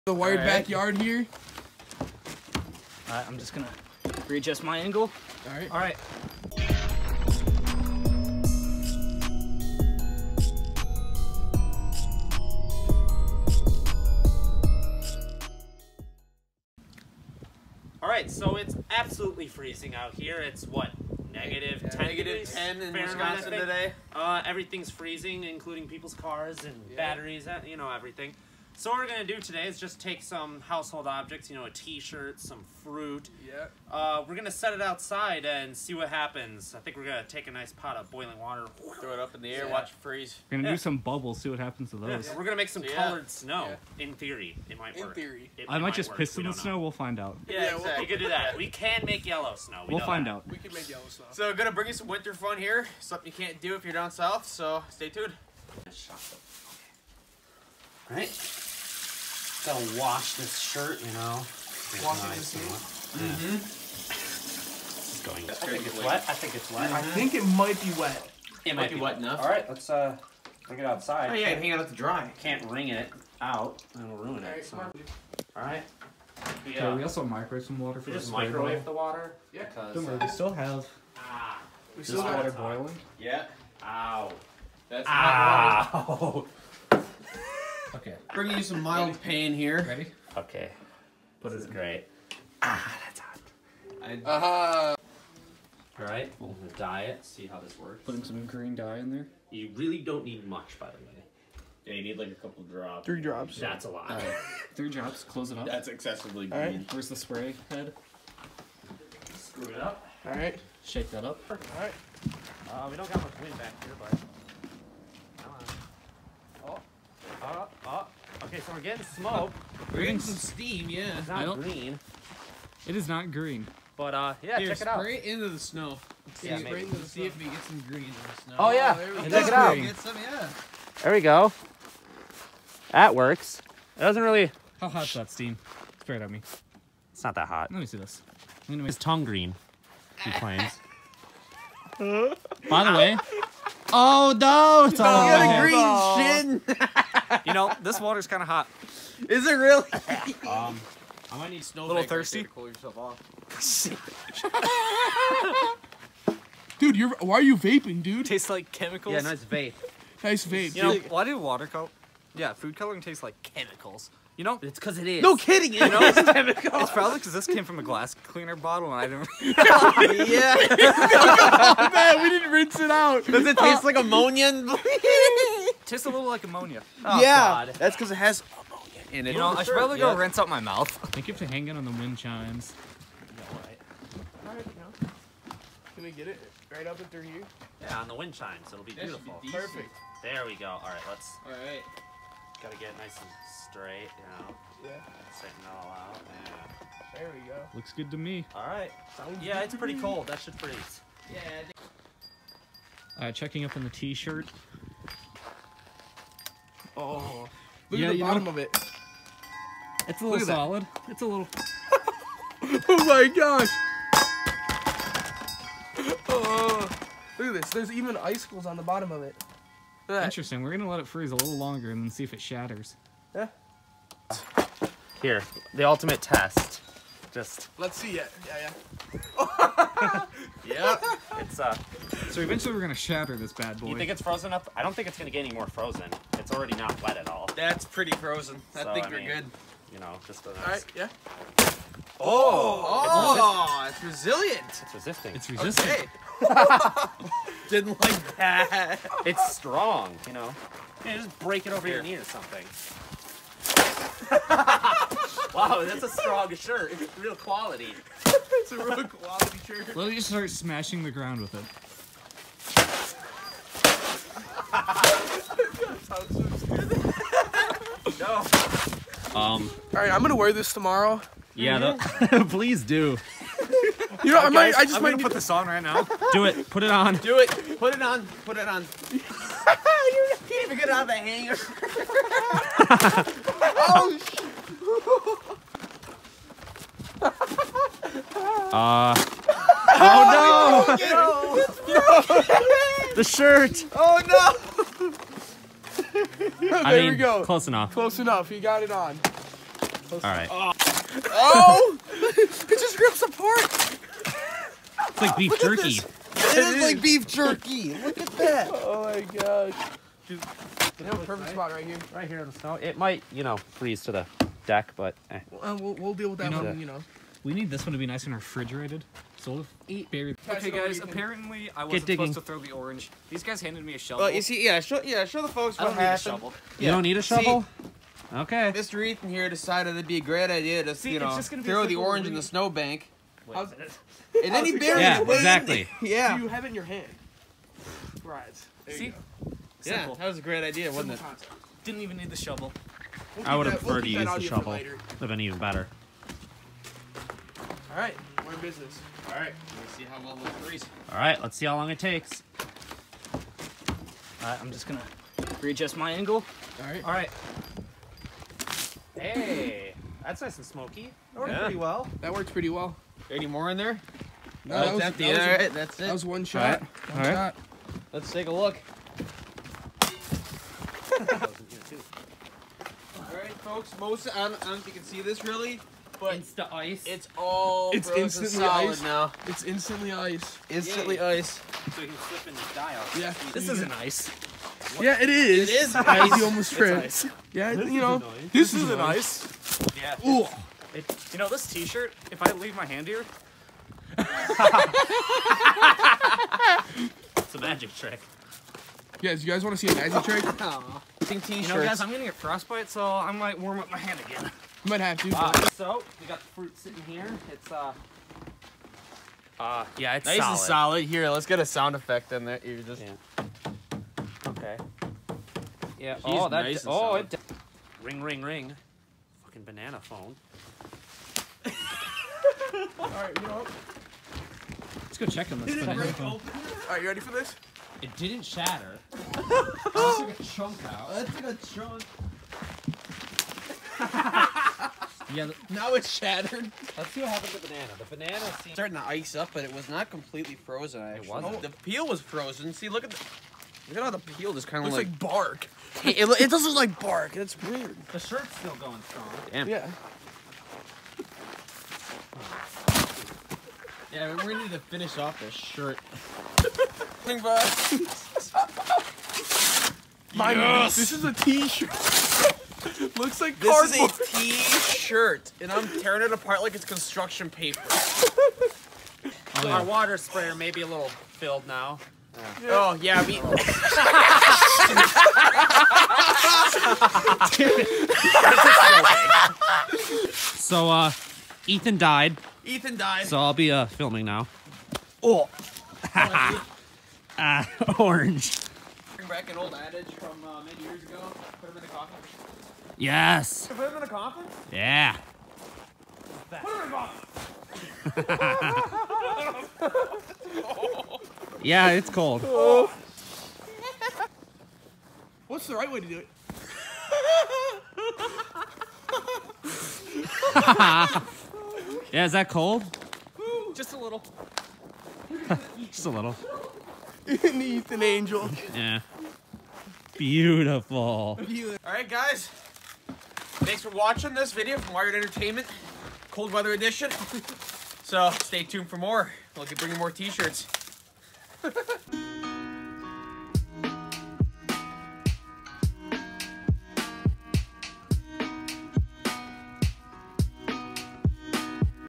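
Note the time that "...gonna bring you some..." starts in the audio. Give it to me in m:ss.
0:51.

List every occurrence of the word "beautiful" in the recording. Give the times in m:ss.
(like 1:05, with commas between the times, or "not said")
3:09, 8:40.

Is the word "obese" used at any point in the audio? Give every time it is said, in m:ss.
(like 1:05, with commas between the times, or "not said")
not said.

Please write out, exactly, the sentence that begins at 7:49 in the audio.
Our water sprayer may be a little filled now.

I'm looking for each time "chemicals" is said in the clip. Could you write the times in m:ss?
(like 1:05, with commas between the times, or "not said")
2:38, 2:43.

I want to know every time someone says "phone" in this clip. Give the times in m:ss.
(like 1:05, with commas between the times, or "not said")
7:00, 7:06.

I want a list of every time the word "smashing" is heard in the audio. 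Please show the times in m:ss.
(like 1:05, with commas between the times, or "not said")
4:20.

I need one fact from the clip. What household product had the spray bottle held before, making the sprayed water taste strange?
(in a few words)
Glass cleaner.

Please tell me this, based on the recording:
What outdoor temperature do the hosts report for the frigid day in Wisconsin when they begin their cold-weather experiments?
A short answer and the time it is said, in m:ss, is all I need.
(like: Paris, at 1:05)
-10, at 0:22.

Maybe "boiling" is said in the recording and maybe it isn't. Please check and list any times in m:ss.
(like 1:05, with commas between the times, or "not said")
0:38, 1:22.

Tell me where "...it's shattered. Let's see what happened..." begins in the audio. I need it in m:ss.
7:15.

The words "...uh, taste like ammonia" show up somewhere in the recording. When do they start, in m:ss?
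2:53.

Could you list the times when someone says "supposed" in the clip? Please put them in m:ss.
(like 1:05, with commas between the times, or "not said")
5:22.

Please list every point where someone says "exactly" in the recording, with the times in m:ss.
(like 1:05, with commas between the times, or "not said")
0:47, 5:35.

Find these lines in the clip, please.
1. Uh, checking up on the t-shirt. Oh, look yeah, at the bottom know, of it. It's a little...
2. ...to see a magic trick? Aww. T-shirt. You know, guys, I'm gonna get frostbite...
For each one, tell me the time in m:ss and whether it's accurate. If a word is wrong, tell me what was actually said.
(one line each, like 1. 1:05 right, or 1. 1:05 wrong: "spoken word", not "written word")
1. 3:23 right
2. 6:39 right.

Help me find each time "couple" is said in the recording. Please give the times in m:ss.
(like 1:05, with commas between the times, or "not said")
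1:42.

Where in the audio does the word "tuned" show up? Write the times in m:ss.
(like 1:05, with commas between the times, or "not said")
0:55, 8:48.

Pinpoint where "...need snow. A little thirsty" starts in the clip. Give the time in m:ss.
2:31.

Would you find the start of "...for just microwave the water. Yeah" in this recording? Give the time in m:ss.
1:18.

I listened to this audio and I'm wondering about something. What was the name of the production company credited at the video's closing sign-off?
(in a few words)
Wyred Entertainment.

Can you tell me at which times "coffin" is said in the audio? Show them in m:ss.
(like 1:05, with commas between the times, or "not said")
8:14.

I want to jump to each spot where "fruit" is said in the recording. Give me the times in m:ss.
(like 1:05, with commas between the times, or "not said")
0:32, 6:46.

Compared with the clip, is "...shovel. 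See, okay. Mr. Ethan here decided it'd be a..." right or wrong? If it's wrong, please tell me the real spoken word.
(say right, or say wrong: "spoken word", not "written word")
right.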